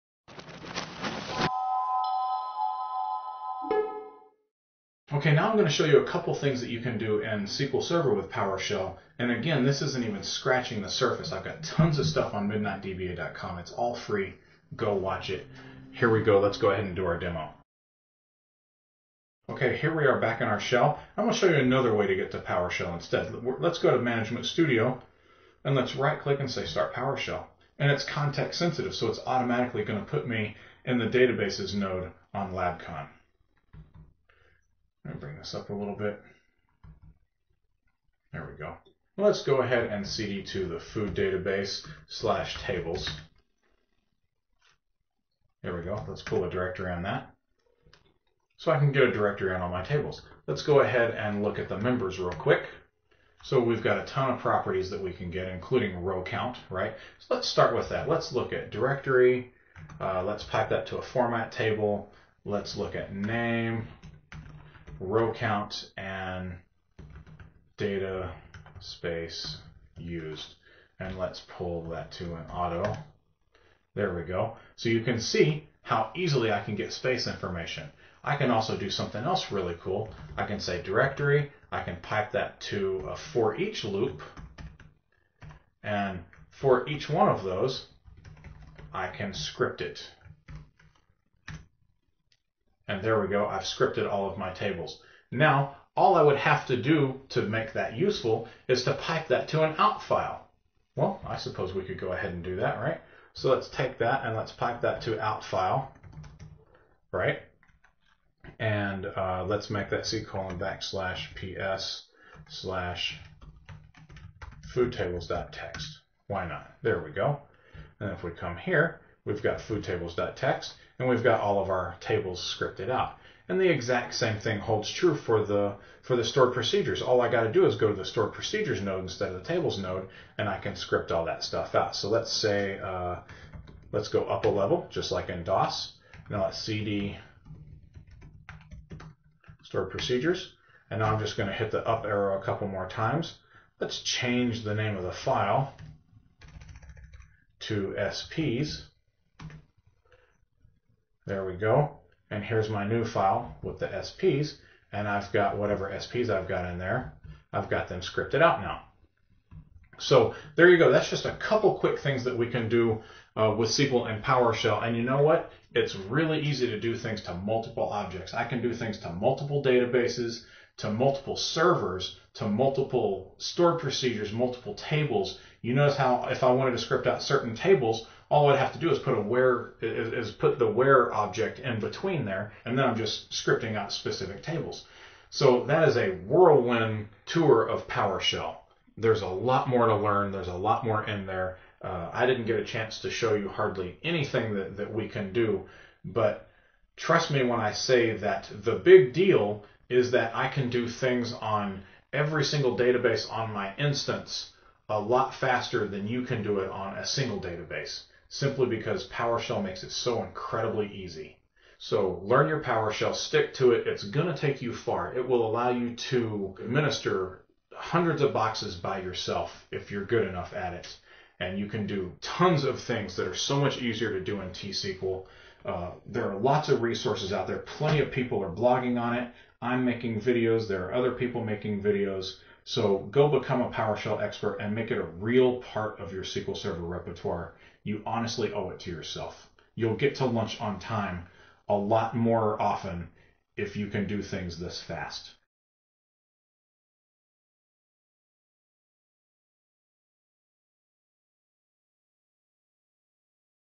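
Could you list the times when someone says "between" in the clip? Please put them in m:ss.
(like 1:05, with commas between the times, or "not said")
3:01.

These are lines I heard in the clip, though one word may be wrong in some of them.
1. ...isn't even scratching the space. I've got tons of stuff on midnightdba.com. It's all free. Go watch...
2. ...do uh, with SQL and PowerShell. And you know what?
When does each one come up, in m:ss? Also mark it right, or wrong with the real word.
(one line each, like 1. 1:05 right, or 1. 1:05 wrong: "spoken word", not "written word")
1. 0:09 wrong: "surface", not "space"
2. 2:42 right.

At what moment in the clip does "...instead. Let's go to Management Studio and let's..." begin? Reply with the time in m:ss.
0:22.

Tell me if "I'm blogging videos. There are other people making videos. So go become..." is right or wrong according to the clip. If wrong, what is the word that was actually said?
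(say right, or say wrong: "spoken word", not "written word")
wrong: "making", not "blogging".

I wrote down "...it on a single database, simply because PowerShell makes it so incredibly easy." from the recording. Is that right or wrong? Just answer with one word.
right.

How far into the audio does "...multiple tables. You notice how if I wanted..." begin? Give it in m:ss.
2:54.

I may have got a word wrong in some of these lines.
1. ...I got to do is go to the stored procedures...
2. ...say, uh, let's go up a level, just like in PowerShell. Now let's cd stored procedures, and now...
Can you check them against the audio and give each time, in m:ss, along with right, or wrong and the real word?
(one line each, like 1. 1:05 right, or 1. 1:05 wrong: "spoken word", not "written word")
1. 2:07 right
2. 2:12 wrong: "DOS", not "PowerShell".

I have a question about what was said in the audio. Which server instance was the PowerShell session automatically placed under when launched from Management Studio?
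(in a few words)
LabCon.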